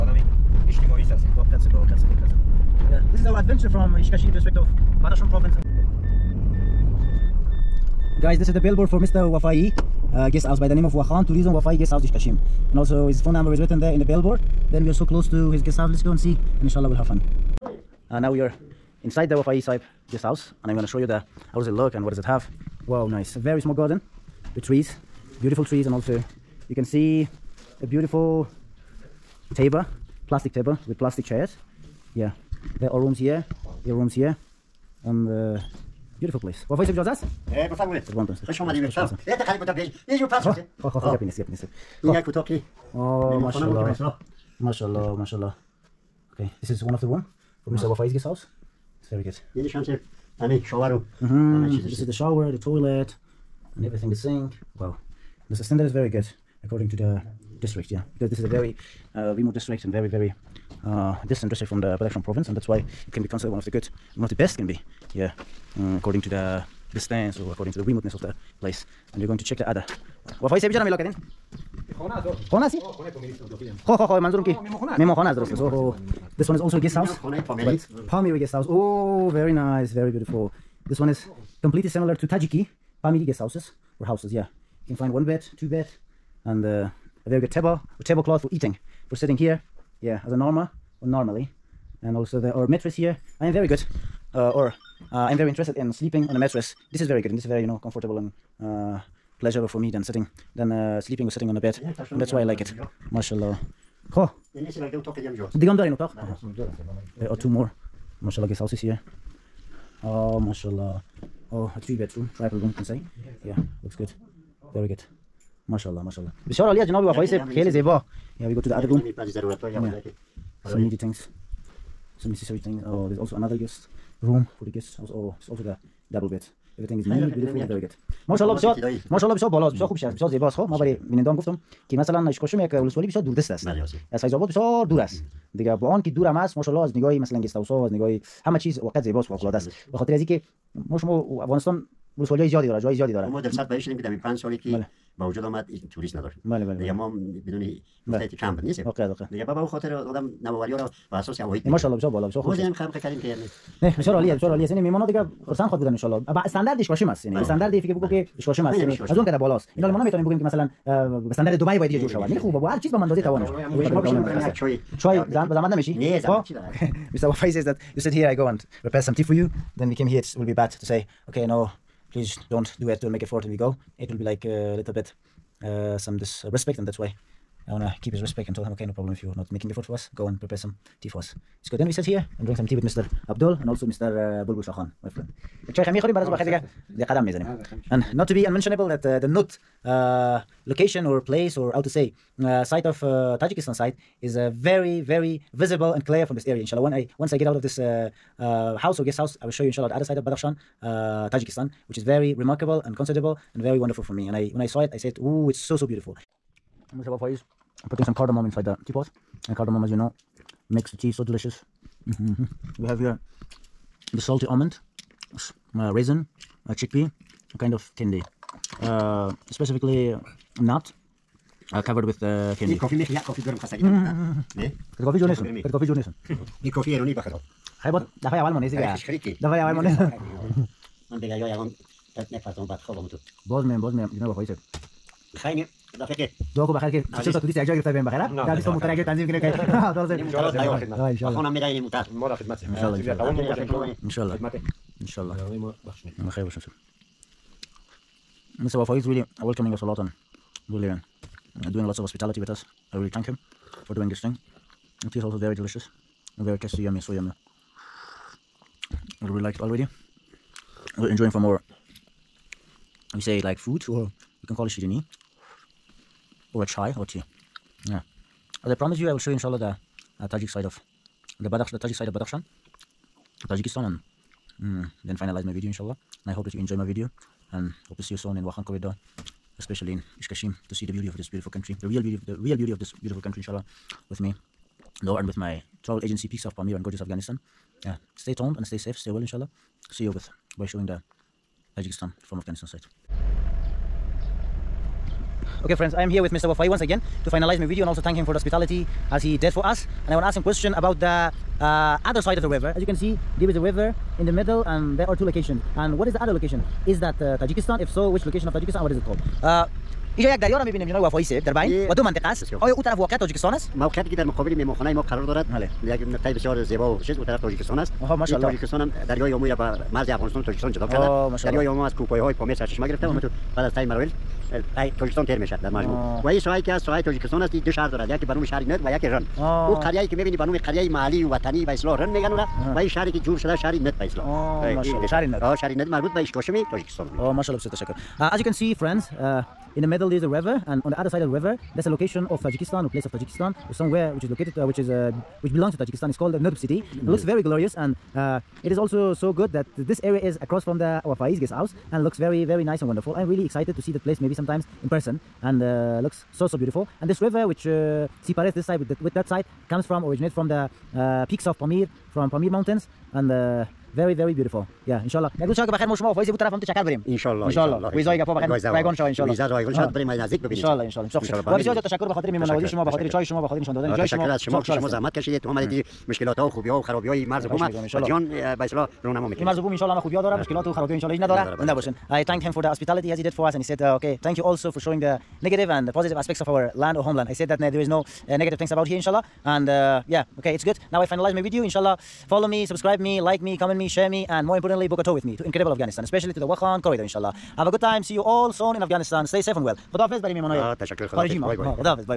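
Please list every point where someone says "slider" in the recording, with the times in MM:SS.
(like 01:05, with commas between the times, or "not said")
not said.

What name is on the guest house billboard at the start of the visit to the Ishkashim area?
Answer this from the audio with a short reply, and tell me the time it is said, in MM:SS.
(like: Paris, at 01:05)
Wahan Tourism Wafai Guest House, at 00:10.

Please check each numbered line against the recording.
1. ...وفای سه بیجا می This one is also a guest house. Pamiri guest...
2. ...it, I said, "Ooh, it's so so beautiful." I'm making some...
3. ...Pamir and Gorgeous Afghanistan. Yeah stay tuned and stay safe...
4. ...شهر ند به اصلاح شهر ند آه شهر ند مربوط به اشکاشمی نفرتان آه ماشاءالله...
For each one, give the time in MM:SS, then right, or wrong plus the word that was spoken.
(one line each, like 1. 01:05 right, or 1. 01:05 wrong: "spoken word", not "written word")
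1. 01:10 right
2. 03:24 wrong: "putting", not "making"
3. 04:46 right
4. 05:33 wrong: "تاجیکستان", not "نفرتان".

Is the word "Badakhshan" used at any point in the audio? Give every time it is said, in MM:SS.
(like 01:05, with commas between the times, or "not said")
00:05, 01:01, 03:20, 04:32.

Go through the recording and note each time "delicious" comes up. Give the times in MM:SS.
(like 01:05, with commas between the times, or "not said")
03:31, 04:15.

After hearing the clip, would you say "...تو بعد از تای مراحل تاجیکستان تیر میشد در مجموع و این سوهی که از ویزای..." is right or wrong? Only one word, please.
wrong.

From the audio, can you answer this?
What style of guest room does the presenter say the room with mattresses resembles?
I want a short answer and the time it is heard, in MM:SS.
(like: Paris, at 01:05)
Tajiki Pamiri, at 01:22.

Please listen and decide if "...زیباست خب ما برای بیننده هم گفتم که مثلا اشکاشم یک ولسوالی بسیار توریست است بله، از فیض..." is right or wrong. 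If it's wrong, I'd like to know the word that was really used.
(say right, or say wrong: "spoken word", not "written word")
wrong: "دوردست", not "توریست".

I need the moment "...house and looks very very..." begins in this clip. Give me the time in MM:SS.
05:51.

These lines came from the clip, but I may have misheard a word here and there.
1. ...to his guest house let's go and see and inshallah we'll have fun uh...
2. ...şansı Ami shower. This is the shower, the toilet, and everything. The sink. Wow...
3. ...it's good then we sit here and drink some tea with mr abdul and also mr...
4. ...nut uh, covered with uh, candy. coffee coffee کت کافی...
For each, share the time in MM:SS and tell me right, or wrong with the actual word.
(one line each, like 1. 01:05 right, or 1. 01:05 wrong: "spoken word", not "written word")
1. 00:15 right
2. 00:49 right
3. 03:01 right
4. 03:40 right.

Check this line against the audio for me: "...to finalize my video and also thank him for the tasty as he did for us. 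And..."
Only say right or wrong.
wrong.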